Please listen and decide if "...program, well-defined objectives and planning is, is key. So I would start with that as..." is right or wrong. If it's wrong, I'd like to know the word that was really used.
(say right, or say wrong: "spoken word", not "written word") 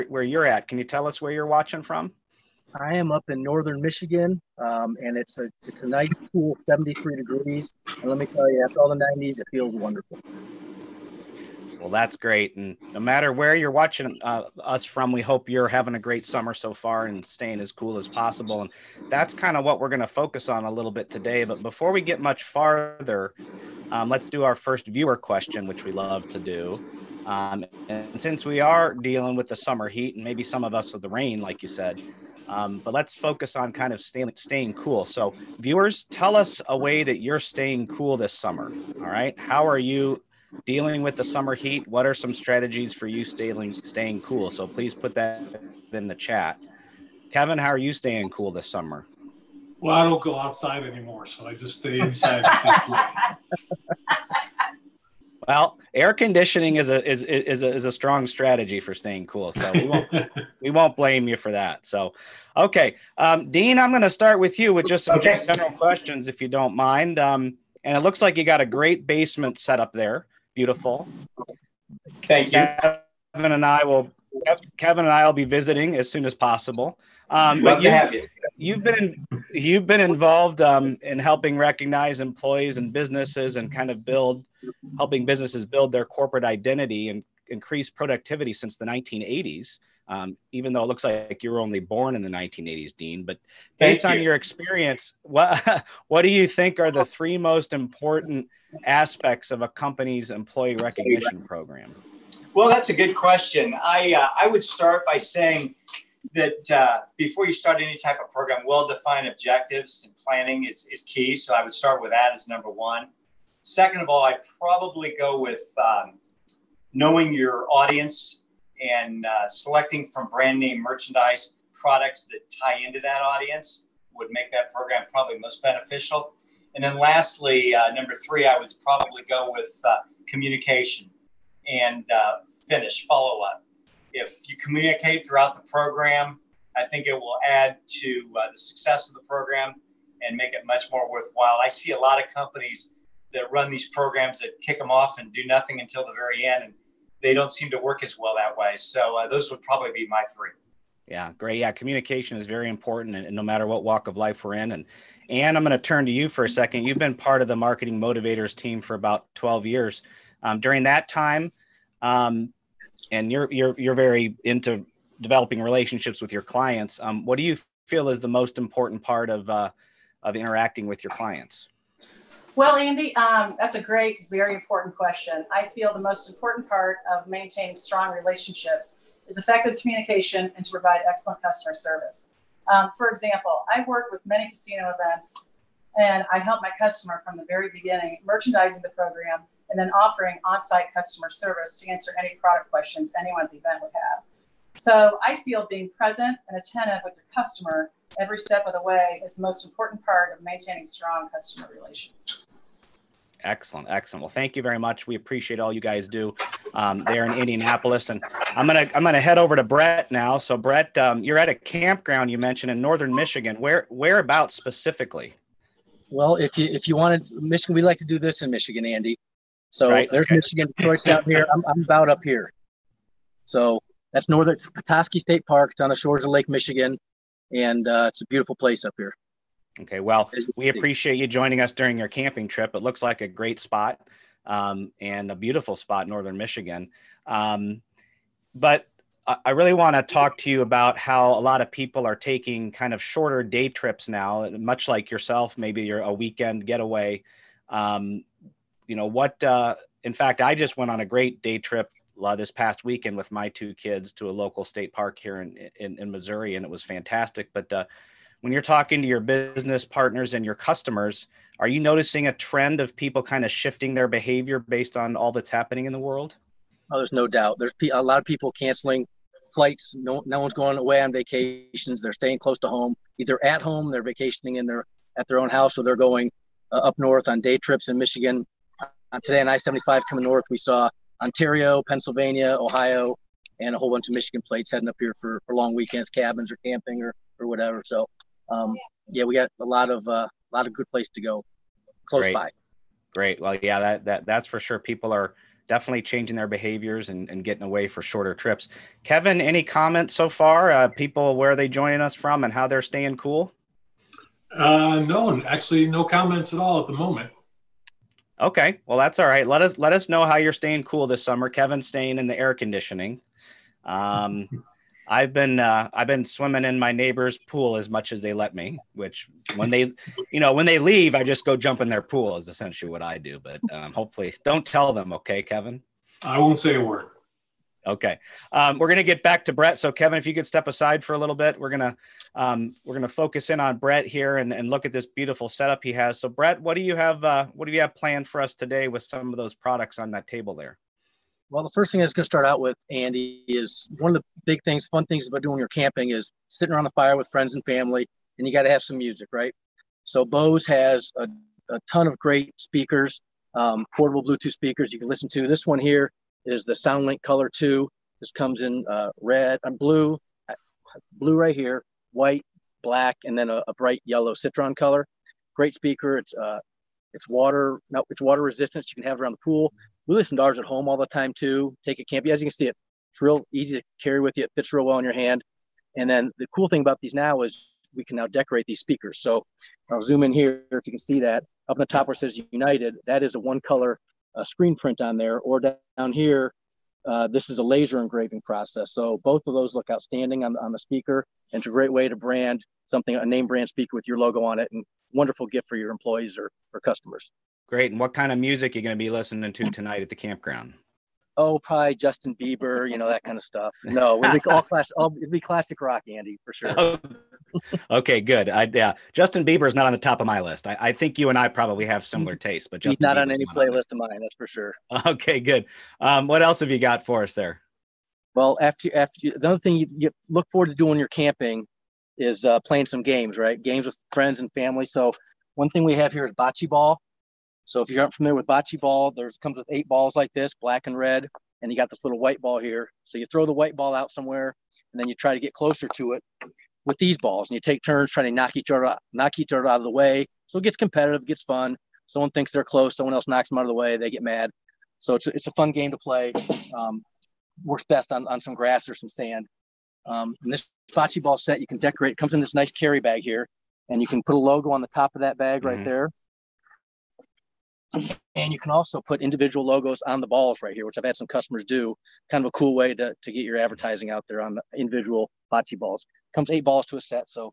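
right.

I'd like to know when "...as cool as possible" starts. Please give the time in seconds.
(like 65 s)
17 s.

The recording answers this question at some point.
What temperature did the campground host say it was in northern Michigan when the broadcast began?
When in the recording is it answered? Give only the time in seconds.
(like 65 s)
6 s.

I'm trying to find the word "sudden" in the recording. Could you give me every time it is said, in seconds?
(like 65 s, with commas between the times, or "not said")
not said.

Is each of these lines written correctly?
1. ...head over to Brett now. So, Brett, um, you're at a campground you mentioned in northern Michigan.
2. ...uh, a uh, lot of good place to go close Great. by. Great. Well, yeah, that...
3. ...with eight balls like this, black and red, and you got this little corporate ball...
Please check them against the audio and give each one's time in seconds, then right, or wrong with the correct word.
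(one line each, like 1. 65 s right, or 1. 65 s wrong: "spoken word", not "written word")
1. 209 s right
2. 290 s right
3. 429 s wrong: "white", not "corporate".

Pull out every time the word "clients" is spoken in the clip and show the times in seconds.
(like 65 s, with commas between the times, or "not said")
166 s, 171 s.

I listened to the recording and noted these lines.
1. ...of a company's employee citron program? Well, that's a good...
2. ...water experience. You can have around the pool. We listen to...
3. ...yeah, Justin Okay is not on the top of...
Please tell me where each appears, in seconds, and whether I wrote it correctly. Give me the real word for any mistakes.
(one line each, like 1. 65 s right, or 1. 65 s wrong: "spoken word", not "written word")
1. 99 s wrong: "recognition", not "citron"
2. 368 s wrong: "resistance", not "experience"
3. 408 s wrong: "Bieber", not "Okay".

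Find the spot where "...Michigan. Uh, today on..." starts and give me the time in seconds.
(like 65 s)
277 s.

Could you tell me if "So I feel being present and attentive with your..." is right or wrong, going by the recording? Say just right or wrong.
right.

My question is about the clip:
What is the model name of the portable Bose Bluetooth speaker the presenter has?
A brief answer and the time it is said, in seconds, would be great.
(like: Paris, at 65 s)
SoundLink Color 2, at 356 s.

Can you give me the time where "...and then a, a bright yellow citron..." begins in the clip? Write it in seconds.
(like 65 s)
363 s.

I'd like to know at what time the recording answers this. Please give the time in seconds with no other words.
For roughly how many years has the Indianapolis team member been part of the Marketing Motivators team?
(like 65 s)
159 s.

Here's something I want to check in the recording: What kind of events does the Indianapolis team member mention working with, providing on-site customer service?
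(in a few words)
casino events.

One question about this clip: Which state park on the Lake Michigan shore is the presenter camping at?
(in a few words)
Petoskey State Park.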